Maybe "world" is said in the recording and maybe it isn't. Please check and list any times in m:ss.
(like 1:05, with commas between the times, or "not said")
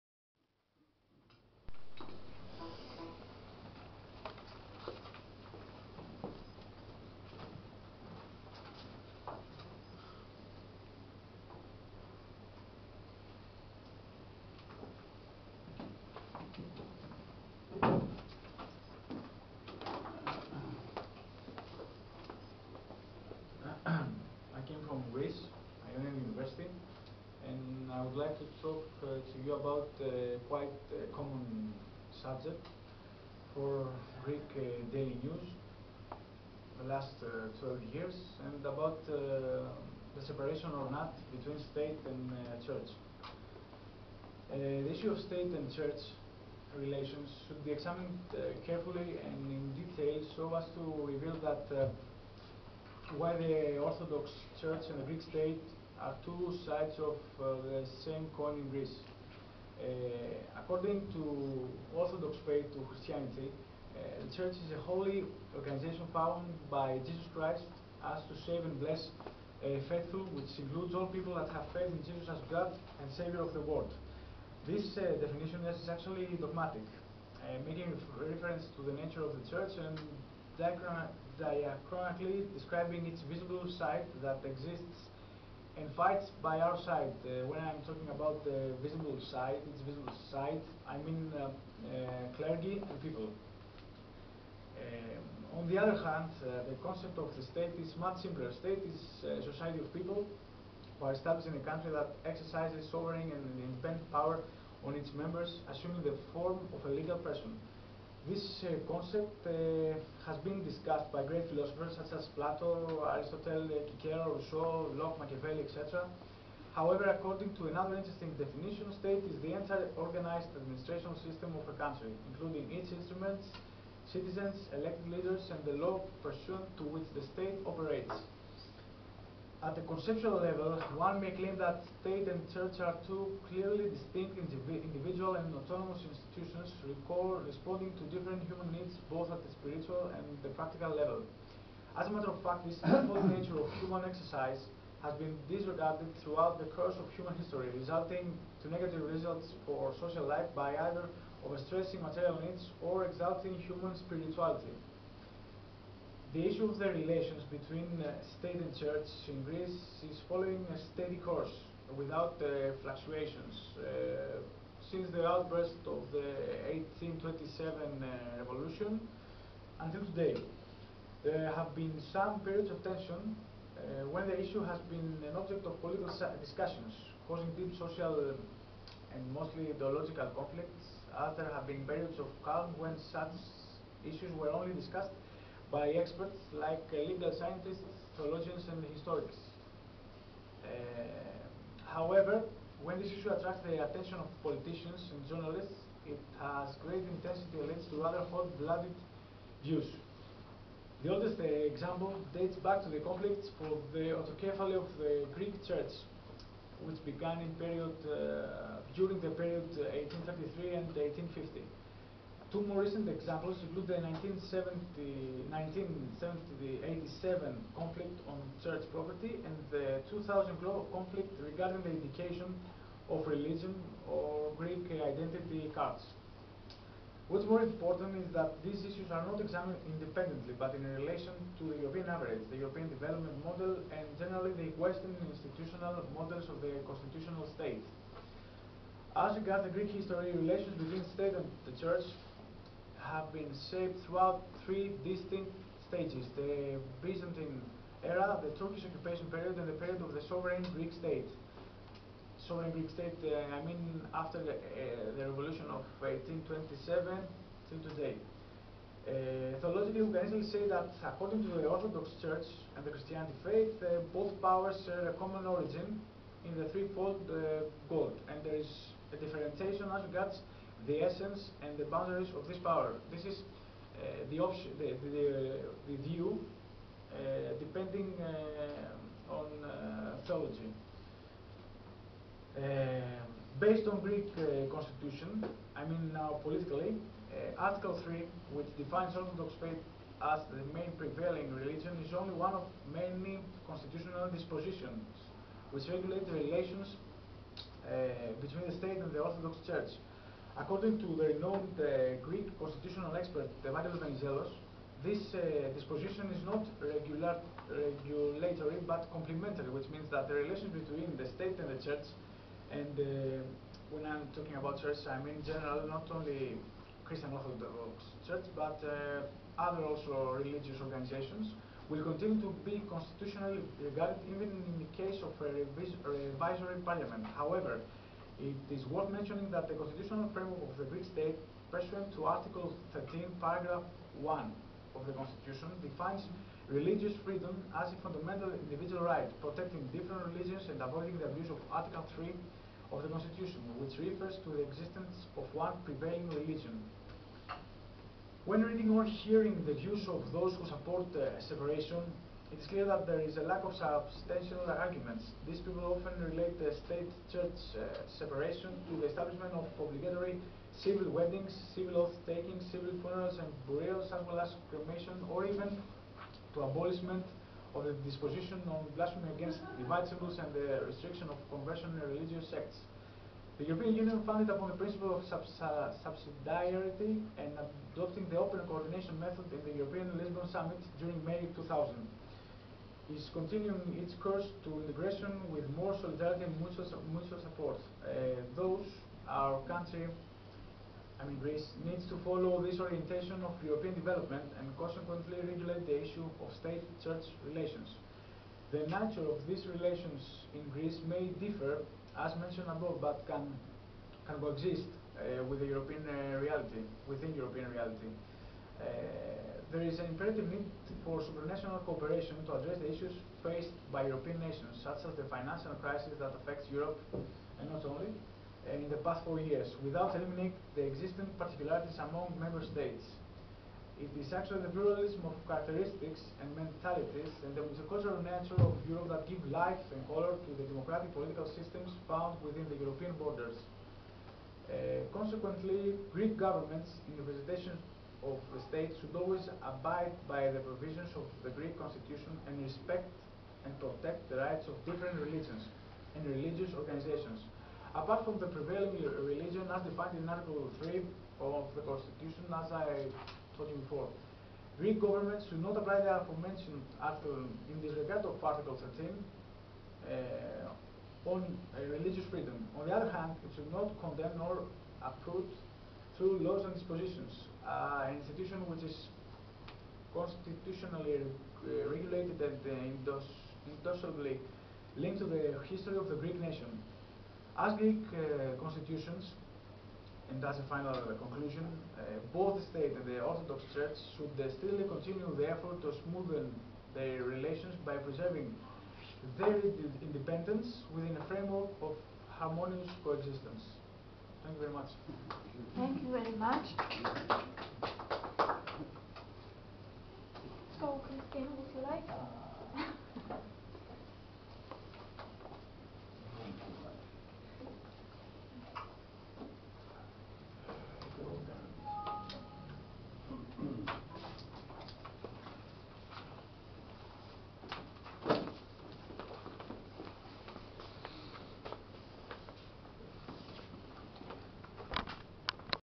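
1:13.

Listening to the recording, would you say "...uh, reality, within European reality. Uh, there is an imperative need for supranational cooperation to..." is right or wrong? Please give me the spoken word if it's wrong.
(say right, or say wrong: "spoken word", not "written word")
right.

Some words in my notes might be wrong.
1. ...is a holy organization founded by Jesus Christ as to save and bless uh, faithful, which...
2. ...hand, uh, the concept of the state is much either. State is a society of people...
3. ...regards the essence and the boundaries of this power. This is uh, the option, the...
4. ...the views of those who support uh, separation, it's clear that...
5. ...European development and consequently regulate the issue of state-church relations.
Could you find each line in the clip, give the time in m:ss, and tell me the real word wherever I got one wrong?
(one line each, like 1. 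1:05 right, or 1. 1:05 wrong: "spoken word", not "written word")
1. 1:04 right
2. 1:36 wrong: "simpler", not "either"
3. 4:30 right
4. 5:49 right
5. 6:33 right.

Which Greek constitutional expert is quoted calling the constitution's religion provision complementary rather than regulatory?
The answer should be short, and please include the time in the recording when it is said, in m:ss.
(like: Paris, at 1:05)
Temarios Venizelos, at 5:03.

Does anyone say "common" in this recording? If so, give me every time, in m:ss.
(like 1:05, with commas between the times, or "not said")
0:31, 4:25.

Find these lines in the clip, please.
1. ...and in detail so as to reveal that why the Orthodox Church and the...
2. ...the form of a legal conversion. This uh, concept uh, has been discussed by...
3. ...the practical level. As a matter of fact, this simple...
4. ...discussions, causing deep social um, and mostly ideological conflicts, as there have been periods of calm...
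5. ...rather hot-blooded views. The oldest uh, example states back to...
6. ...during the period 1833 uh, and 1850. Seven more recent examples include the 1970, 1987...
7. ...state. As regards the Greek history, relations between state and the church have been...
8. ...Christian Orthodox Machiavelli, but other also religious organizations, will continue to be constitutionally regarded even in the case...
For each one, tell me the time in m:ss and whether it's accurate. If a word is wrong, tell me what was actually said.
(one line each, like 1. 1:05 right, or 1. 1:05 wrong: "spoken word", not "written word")
1. 0:49 right
2. 1:46 wrong: "person", not "conversion"
3. 2:20 right
4. 2:56 right
5. 3:18 wrong: "dates", not "states"
6. 3:28 wrong: "Two", not "Seven"
7. 3:57 right
8. 5:17 wrong: "Church", not "Machiavelli".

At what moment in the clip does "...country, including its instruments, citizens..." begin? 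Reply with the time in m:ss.
2:01.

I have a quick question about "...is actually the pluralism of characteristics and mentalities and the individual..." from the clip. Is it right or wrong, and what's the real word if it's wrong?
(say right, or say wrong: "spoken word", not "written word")
wrong: "multicultural", not "individual".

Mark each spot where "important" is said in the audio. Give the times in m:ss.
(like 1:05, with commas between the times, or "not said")
3:47.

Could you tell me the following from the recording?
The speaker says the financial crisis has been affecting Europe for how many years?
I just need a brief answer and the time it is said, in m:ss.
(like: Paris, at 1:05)
4, at 6:59.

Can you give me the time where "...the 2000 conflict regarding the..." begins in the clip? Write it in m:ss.
3:39.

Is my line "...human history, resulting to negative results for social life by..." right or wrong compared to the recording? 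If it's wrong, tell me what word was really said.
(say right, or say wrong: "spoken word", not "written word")
right.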